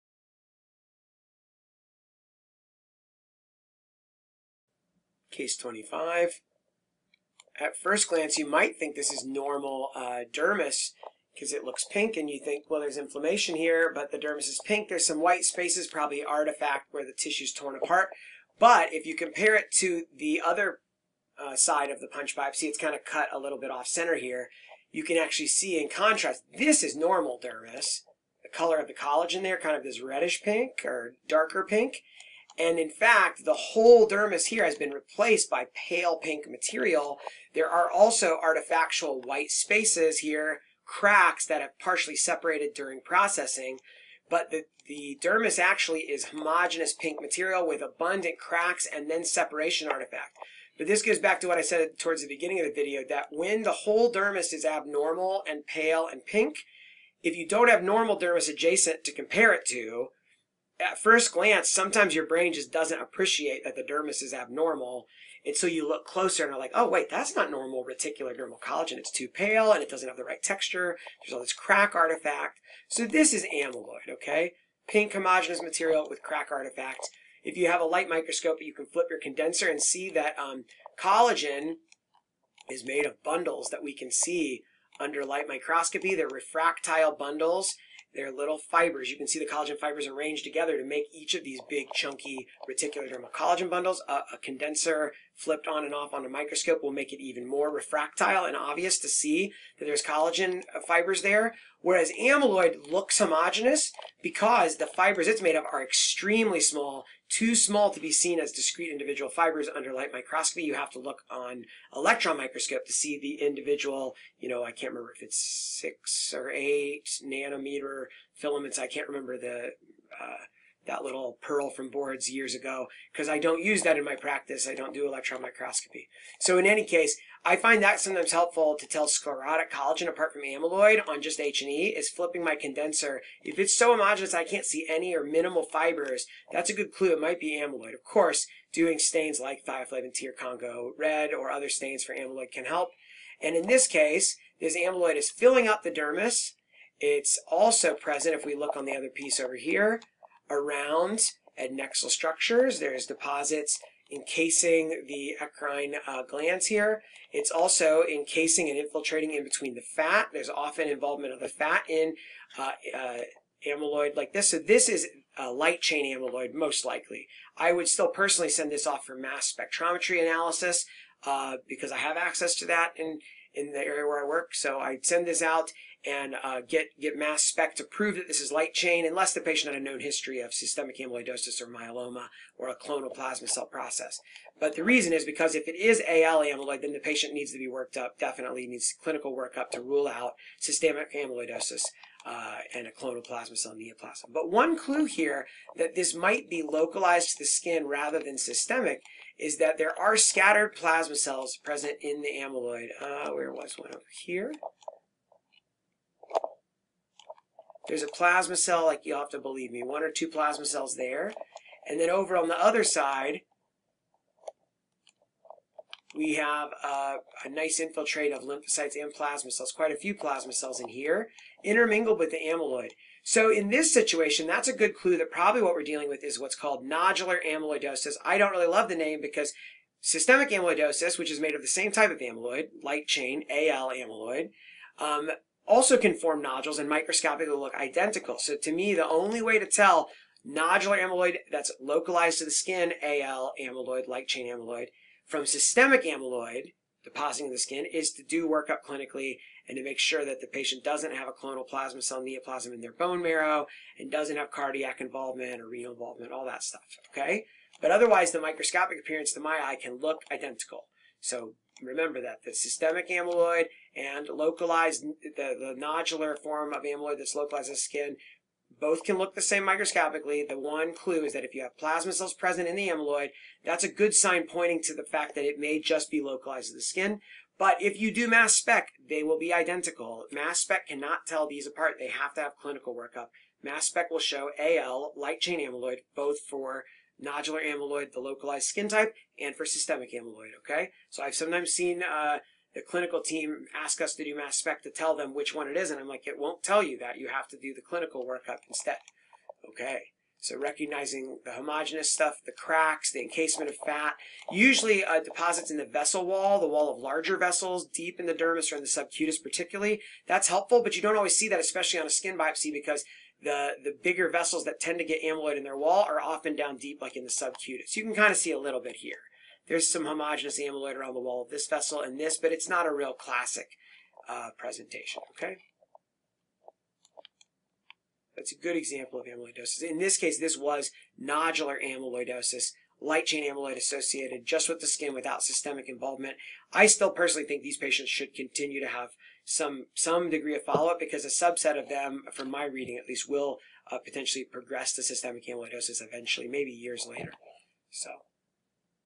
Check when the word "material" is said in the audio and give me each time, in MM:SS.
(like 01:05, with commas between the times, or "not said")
00:36, 00:47, 01:15.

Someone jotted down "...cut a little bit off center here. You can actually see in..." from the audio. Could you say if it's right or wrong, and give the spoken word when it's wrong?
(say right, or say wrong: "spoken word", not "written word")
right.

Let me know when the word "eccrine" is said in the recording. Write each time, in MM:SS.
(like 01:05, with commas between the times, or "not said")
02:35.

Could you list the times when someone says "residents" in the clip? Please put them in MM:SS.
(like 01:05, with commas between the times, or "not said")
not said.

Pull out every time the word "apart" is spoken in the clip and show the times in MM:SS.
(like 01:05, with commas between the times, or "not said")
00:17, 02:10, 04:41.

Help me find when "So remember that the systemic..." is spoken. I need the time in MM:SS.
04:21.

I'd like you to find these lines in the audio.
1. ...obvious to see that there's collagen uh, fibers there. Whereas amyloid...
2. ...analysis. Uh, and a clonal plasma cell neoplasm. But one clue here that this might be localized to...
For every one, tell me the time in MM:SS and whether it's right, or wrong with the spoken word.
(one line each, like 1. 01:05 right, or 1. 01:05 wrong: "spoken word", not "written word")
1. 01:38 right
2. 03:11 wrong: "amyloidosis", not "analysis".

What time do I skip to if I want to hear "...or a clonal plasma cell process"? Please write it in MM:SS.
03:02.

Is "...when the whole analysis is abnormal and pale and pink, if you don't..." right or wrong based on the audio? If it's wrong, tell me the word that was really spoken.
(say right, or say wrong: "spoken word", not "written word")
wrong: "dermis", not "analysis".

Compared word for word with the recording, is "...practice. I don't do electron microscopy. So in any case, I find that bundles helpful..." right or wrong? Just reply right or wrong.
wrong.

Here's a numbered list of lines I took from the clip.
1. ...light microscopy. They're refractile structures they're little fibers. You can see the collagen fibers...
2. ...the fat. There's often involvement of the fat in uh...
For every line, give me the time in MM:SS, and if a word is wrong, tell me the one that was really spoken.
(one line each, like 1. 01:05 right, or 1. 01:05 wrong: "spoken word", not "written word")
1. 01:25 wrong: "bundles", not "structures"
2. 02:39 right.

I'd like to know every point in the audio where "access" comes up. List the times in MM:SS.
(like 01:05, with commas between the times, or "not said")
02:52.